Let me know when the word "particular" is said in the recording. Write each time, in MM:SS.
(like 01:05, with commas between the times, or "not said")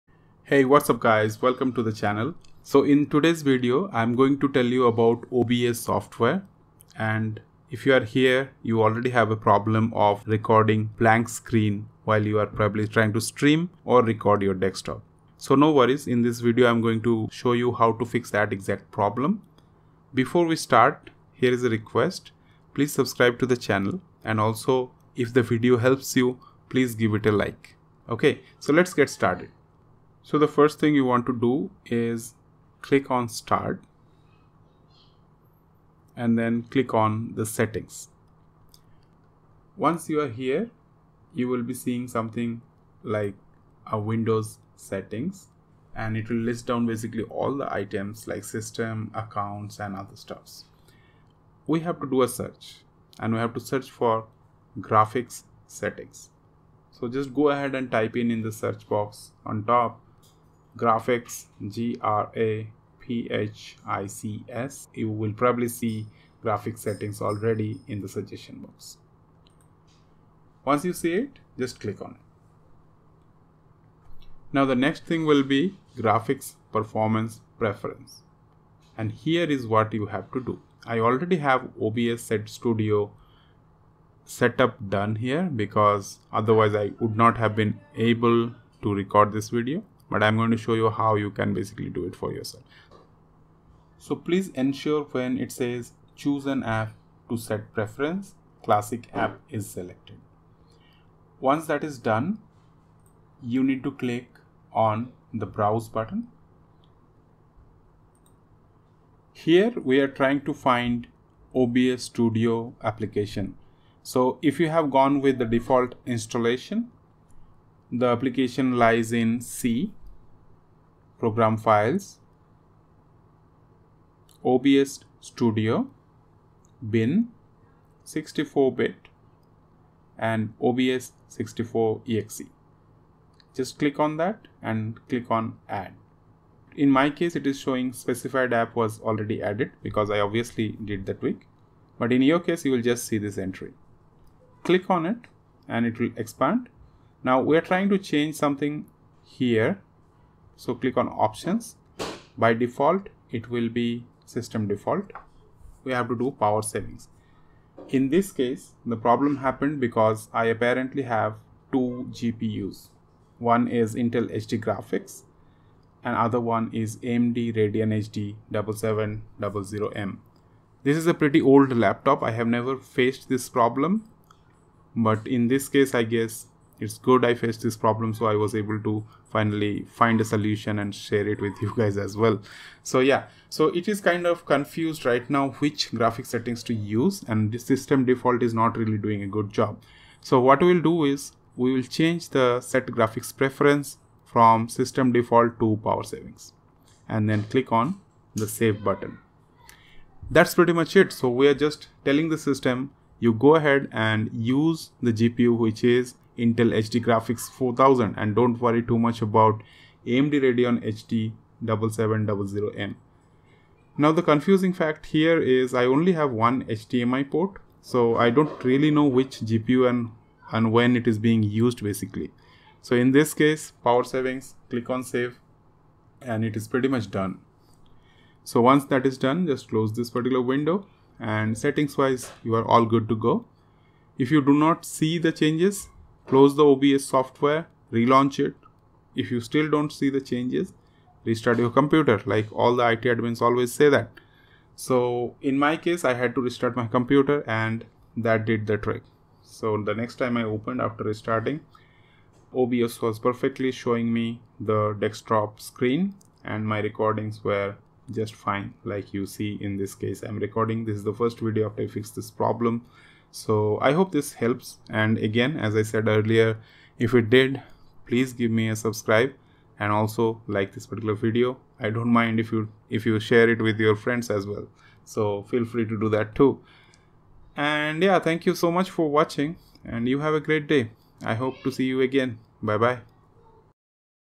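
03:50, 04:30.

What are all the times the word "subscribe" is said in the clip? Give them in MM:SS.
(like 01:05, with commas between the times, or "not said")
00:22, 04:28.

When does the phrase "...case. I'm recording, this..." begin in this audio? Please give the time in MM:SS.
04:20.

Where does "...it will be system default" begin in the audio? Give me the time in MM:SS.
02:33.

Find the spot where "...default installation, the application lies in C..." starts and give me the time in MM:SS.
01:55.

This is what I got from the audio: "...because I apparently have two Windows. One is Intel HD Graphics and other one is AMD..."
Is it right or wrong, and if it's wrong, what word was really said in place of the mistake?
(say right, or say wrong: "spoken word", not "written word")
wrong: "GPUs", not "Windows".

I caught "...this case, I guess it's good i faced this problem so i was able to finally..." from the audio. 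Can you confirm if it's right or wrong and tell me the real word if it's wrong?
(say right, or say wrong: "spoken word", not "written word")
right.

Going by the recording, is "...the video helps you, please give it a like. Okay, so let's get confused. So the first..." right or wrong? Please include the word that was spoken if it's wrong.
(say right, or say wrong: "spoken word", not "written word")
wrong: "started", not "confused".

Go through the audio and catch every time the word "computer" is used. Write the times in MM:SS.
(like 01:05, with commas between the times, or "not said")
04:01, 04:06.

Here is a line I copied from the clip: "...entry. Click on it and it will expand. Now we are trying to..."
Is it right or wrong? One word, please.
right.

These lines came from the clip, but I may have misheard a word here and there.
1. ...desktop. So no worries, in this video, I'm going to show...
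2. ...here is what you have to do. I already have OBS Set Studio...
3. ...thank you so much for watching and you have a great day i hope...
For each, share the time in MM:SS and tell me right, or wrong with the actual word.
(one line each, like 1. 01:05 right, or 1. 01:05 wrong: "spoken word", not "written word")
1. 00:14 right
2. 01:19 right
3. 04:38 right.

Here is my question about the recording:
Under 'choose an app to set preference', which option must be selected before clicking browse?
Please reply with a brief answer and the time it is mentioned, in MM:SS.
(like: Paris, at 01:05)
classic app, at 01:38.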